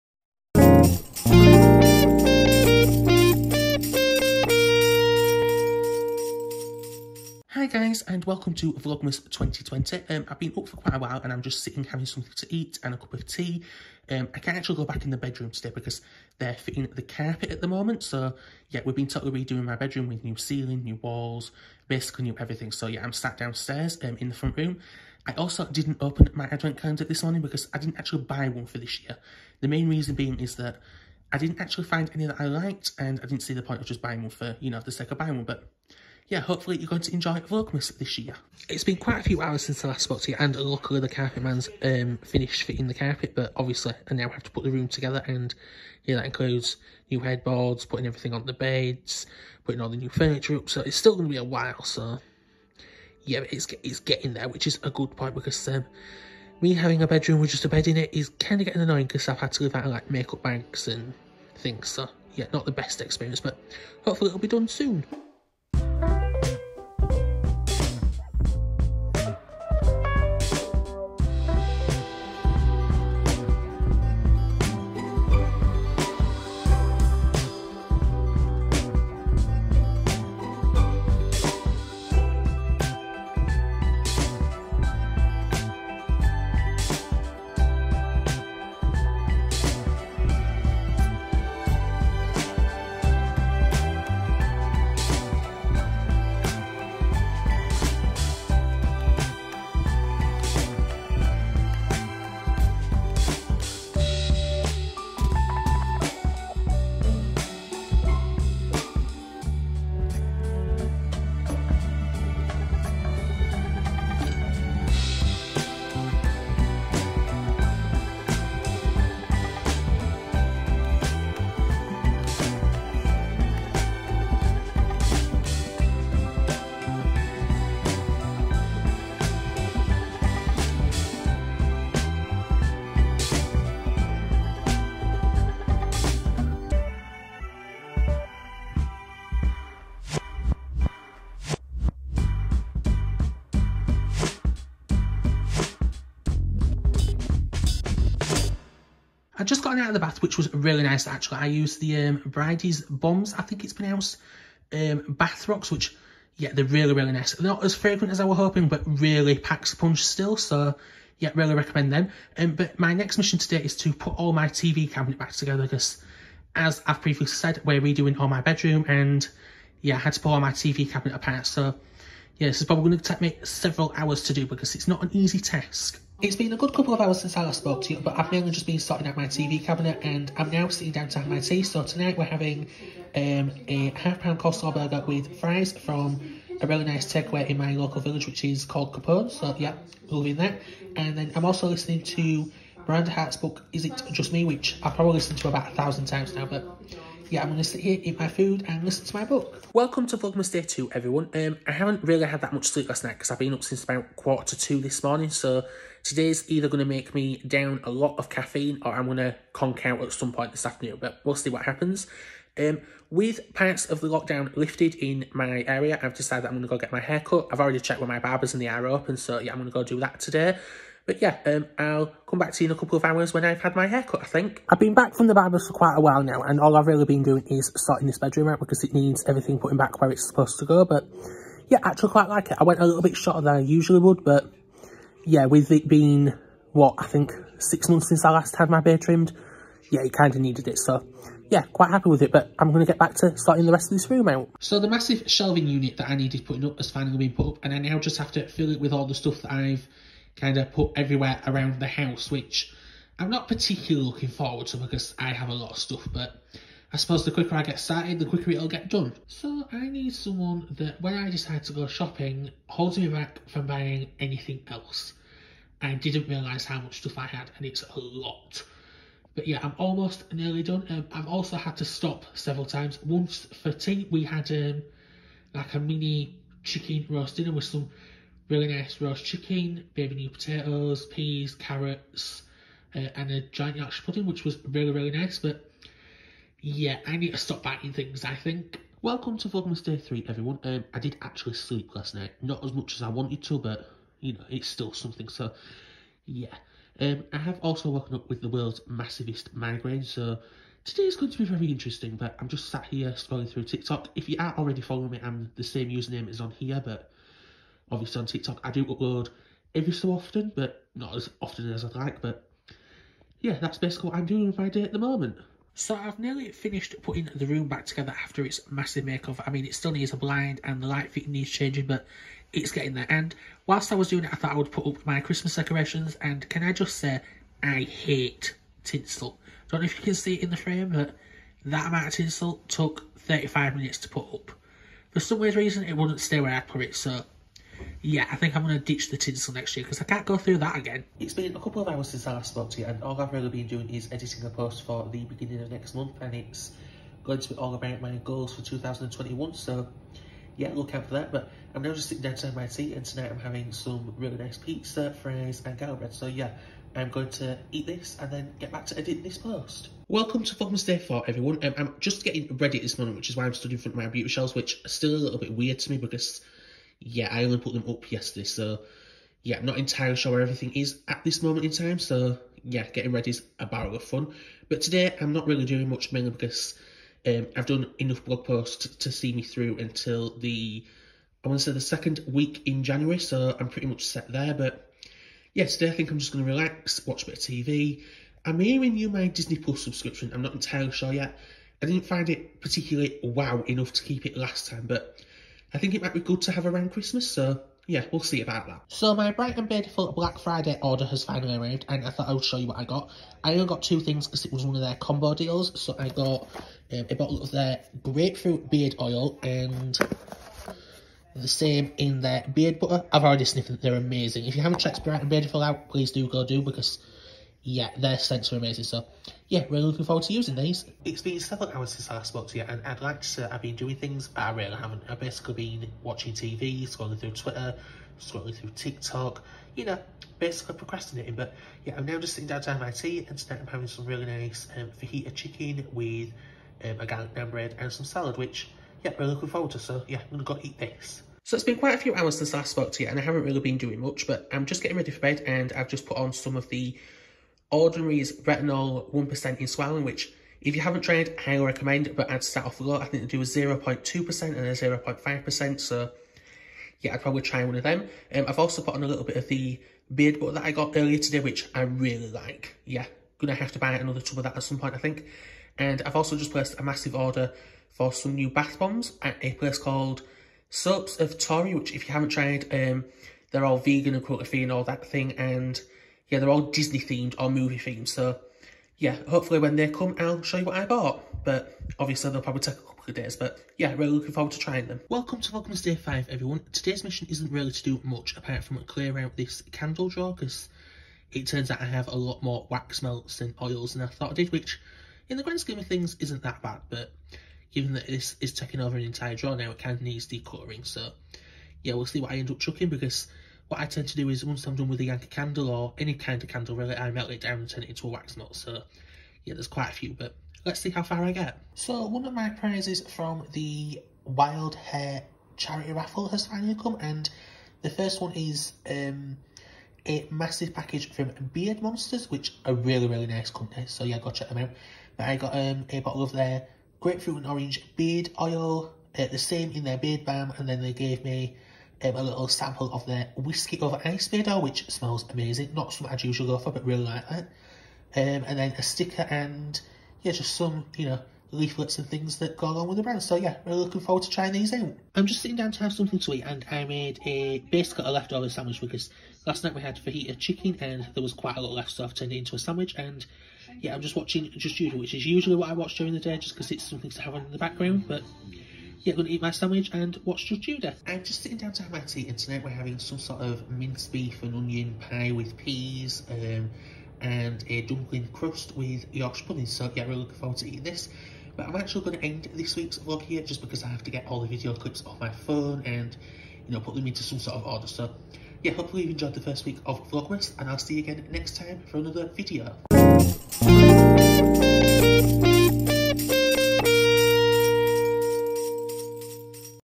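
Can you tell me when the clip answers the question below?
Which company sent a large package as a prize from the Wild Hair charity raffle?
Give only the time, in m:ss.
8:41.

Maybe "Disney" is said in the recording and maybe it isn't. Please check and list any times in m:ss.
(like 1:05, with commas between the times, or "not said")
6:29, 7:56.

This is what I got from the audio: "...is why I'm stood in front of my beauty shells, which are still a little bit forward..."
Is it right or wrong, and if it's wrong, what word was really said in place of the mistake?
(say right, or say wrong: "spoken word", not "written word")
wrong: "weird", not "forward".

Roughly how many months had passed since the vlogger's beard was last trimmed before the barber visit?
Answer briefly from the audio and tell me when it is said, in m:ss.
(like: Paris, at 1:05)
6, at 3:57.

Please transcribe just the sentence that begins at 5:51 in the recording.
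But I'm now just sitting down to my tea and tonight I'm having some really nice pizza, fries and garlic bread.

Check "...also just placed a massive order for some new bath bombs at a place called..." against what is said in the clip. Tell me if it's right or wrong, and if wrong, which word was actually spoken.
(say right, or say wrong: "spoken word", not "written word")
right.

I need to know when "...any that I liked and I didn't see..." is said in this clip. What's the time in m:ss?
0:32.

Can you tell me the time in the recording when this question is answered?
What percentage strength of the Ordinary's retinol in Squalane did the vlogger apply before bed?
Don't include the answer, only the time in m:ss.
7:29.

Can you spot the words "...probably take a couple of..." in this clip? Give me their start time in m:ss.
8:02.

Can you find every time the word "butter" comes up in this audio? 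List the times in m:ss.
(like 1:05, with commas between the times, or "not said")
6:52, 7:40.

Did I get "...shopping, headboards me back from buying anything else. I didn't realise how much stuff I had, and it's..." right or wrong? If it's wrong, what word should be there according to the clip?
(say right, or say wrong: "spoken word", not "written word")
wrong: "holds", not "headboards".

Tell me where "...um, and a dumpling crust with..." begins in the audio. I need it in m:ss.
9:26.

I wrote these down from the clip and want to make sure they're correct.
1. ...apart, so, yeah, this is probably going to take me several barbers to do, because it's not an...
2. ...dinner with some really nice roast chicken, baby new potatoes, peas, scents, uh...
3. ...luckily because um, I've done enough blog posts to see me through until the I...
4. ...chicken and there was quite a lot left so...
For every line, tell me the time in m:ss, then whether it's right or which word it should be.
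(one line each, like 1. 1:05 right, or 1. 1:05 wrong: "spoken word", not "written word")
1. 2:51 wrong: "hours", not "barbers"
2. 4:37 wrong: "carrots", not "scents"
3. 6:16 wrong: "mainly", not "luckily"
4. 9:10 right.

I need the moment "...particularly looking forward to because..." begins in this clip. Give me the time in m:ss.
4:13.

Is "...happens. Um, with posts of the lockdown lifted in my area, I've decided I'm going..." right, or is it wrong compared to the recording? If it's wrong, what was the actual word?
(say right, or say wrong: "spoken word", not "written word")
wrong: "parts", not "posts".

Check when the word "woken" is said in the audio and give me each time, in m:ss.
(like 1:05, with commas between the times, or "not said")
4:57.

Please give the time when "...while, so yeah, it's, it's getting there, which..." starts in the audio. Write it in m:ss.
0:51.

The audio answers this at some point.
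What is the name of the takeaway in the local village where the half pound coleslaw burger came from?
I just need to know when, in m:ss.
3:08.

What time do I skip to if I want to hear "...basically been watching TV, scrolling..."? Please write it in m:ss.
7:05.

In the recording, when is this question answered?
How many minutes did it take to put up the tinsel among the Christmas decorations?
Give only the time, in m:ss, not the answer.
5:33.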